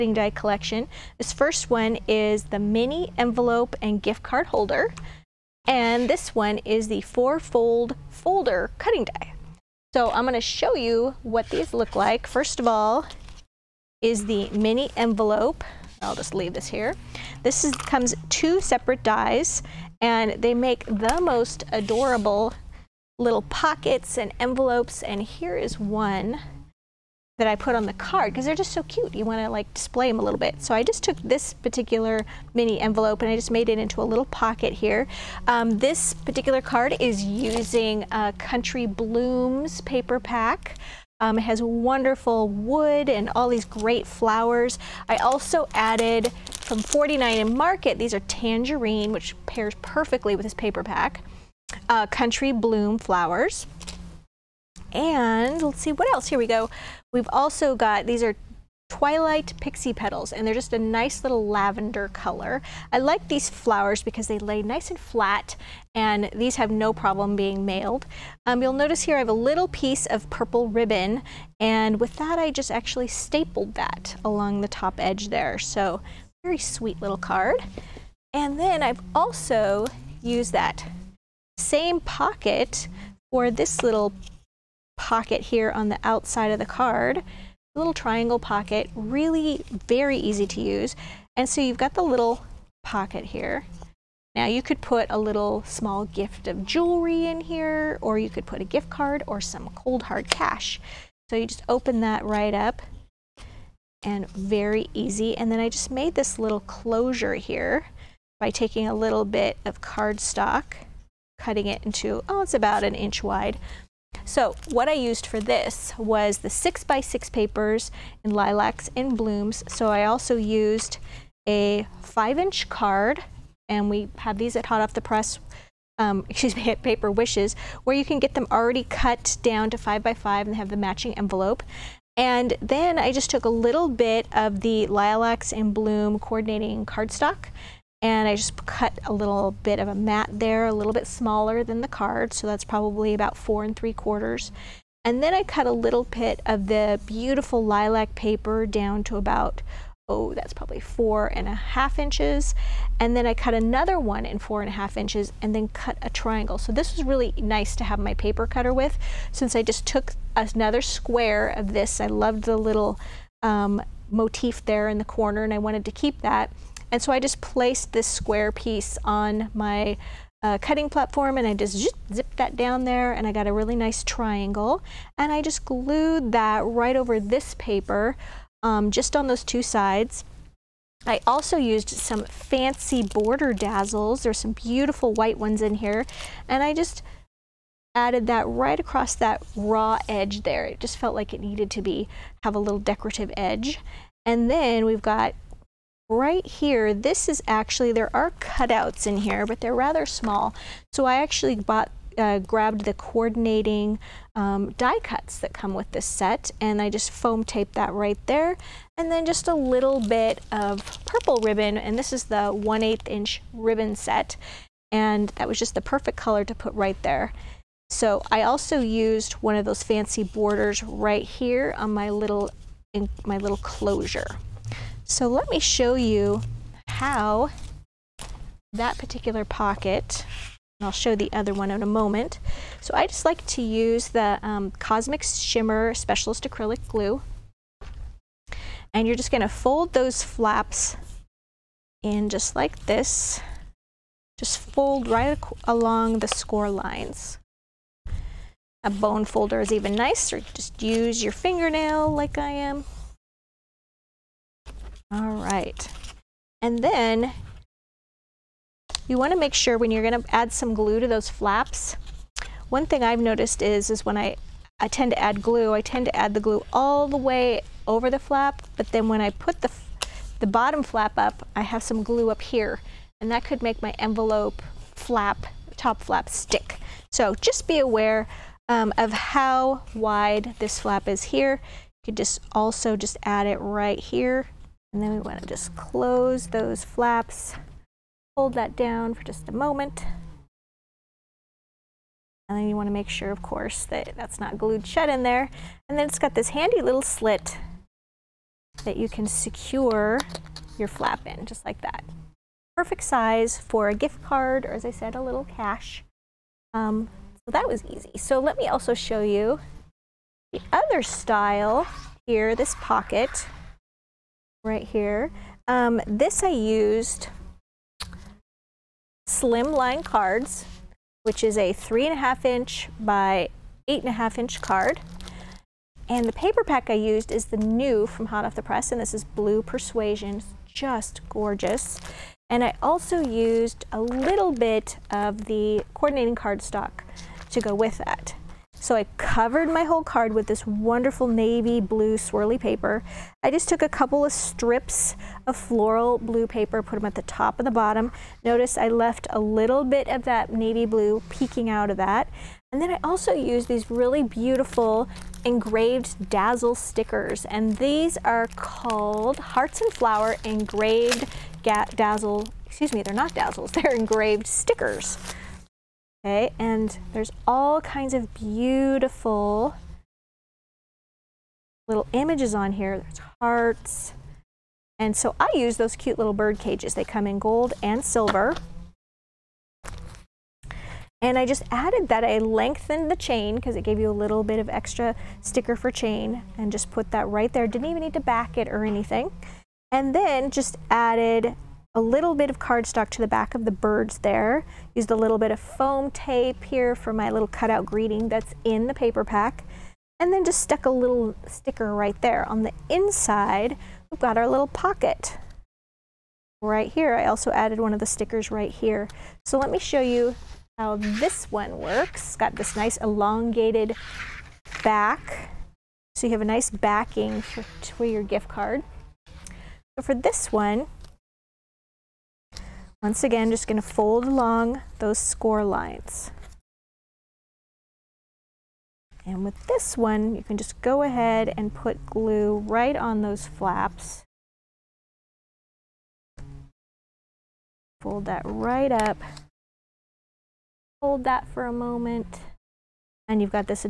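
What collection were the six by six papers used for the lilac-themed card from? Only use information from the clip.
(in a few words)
Lilacs and Blooms.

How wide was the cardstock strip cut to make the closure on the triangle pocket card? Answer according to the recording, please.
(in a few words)
About an inch.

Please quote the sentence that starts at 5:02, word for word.
Perfect size for a gift card, or as I said, a little cash.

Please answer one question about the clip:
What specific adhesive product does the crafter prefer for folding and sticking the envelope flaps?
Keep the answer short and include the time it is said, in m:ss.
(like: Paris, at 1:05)
Cosmic Shimmer Specialist Acrylic Glue, at 3:54.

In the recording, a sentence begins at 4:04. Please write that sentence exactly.
Just fold right along the score lines.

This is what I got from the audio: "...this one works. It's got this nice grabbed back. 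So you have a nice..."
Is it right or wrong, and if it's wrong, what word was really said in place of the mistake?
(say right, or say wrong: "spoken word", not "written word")
wrong: "elongated", not "grabbed".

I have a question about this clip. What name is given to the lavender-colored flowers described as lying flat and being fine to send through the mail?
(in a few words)
Twilight Pixie Petals.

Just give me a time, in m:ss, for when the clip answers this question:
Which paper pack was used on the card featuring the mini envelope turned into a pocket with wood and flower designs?
0:38.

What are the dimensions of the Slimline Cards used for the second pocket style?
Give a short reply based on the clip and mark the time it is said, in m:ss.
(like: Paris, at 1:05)
3.5 by 8.5 inches, at 5:21.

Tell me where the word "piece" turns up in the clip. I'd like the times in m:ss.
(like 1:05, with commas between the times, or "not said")
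1:09, 2:48.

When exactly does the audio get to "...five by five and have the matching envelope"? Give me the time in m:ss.
2:09.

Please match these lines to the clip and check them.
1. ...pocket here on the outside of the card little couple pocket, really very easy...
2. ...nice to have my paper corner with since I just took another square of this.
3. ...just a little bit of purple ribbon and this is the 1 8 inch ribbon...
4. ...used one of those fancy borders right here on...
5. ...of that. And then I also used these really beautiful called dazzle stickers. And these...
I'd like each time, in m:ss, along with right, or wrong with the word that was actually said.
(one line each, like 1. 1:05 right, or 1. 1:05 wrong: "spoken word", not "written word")
1. 1:24 wrong: "triangle", not "couple"
2. 2:37 wrong: "cutter", not "corner"
3. 3:29 right
4. 3:38 right
5. 5:51 wrong: "engraved", not "called".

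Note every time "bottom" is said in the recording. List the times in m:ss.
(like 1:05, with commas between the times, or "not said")
4:30, 5:47.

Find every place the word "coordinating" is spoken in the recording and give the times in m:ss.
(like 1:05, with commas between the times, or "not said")
2:16, 3:22, 5:35.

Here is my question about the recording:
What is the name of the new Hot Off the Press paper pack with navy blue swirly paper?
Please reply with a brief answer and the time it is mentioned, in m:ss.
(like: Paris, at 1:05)
Blue Persuasion, at 5:29.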